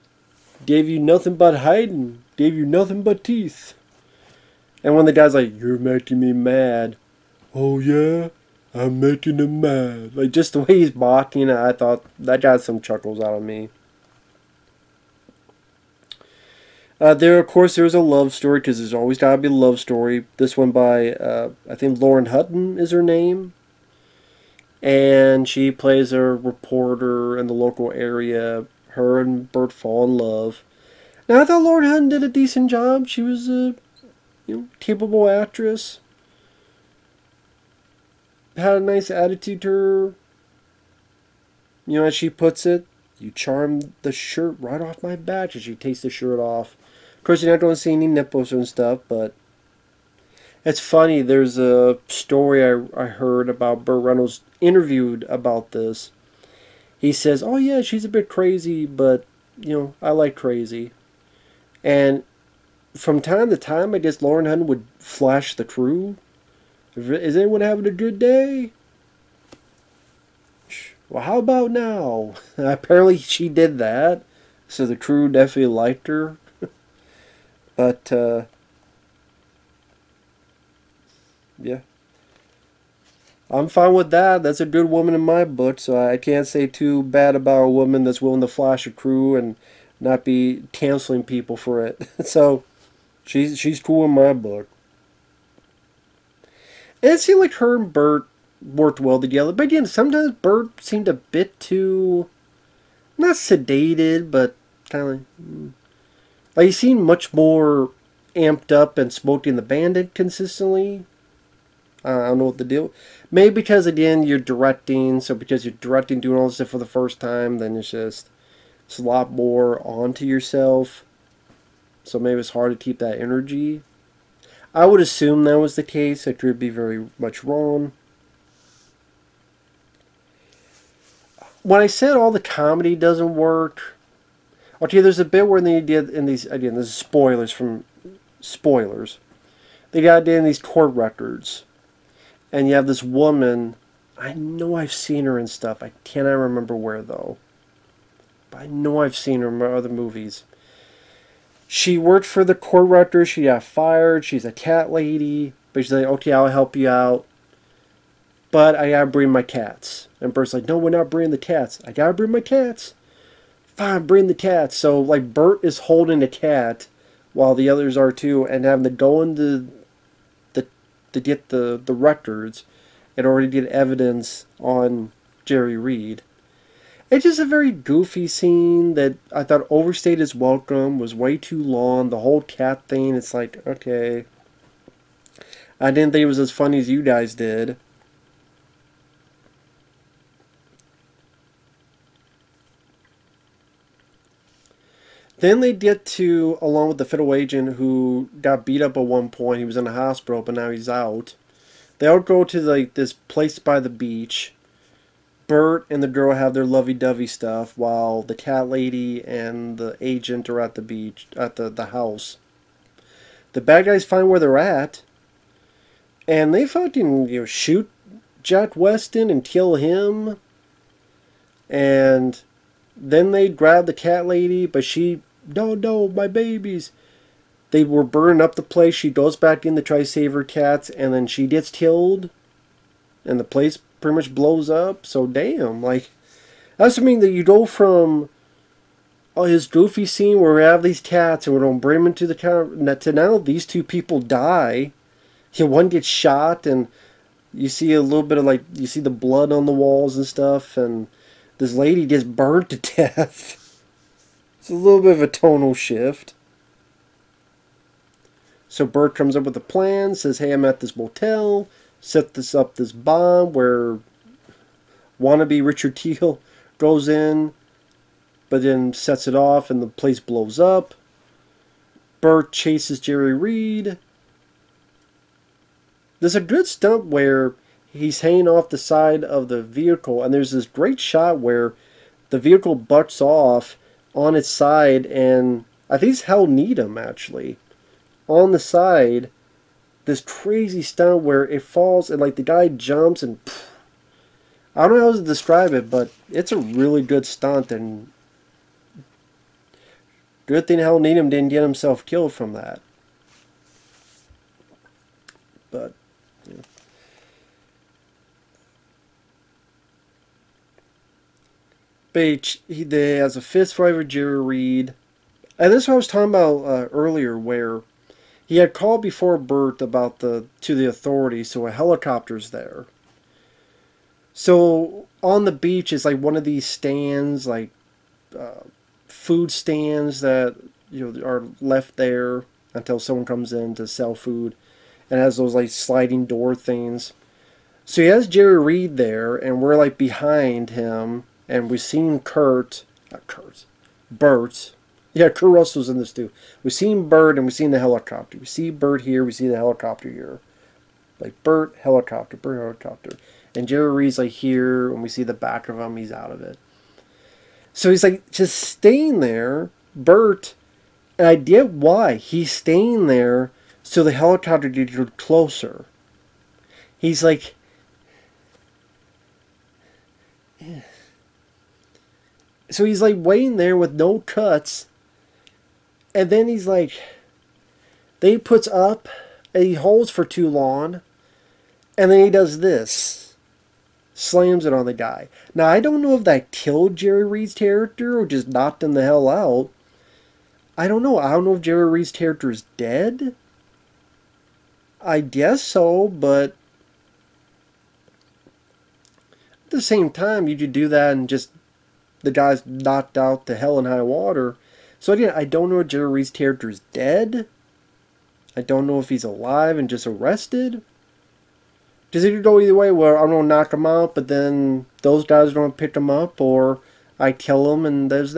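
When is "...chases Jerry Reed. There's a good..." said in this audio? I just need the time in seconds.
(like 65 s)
272 s.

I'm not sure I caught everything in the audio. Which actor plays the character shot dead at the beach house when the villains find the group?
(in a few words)
Jack Weston.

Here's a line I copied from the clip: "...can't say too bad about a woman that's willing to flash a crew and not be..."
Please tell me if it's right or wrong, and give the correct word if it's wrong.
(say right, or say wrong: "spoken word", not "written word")
right.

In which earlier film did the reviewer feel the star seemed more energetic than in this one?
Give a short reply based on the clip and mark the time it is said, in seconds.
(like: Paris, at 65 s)
Smokey and the Bandit, at 109 s.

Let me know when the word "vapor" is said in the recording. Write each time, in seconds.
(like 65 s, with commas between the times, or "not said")
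not said.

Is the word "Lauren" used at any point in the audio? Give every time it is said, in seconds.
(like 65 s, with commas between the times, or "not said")
22 s, 31 s, 64 s.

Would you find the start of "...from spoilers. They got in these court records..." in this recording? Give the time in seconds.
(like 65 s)
137 s.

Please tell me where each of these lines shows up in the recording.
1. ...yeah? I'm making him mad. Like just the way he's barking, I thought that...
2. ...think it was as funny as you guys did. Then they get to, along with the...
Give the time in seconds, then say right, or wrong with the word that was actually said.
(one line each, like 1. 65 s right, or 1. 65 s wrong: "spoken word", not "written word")
1. 7 s right
2. 186 s right.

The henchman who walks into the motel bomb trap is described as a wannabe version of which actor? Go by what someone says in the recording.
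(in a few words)
Richard Kiel.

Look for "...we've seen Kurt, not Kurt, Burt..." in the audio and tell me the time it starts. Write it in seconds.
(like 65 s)
341 s.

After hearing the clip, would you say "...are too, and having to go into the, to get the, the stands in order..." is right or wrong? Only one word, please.
wrong.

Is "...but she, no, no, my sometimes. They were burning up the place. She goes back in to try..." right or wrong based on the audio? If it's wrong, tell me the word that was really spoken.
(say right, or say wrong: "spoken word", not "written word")
wrong: "babies", not "sometimes".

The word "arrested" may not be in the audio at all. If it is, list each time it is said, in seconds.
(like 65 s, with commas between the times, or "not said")
410 s.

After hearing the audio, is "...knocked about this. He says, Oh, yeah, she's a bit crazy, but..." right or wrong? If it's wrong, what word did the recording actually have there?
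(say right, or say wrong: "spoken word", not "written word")
wrong: "interviewed", not "knocked".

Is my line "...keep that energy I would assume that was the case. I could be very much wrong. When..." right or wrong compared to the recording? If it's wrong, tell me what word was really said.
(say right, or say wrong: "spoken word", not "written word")
right.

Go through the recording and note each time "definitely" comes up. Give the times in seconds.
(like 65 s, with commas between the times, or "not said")
75 s.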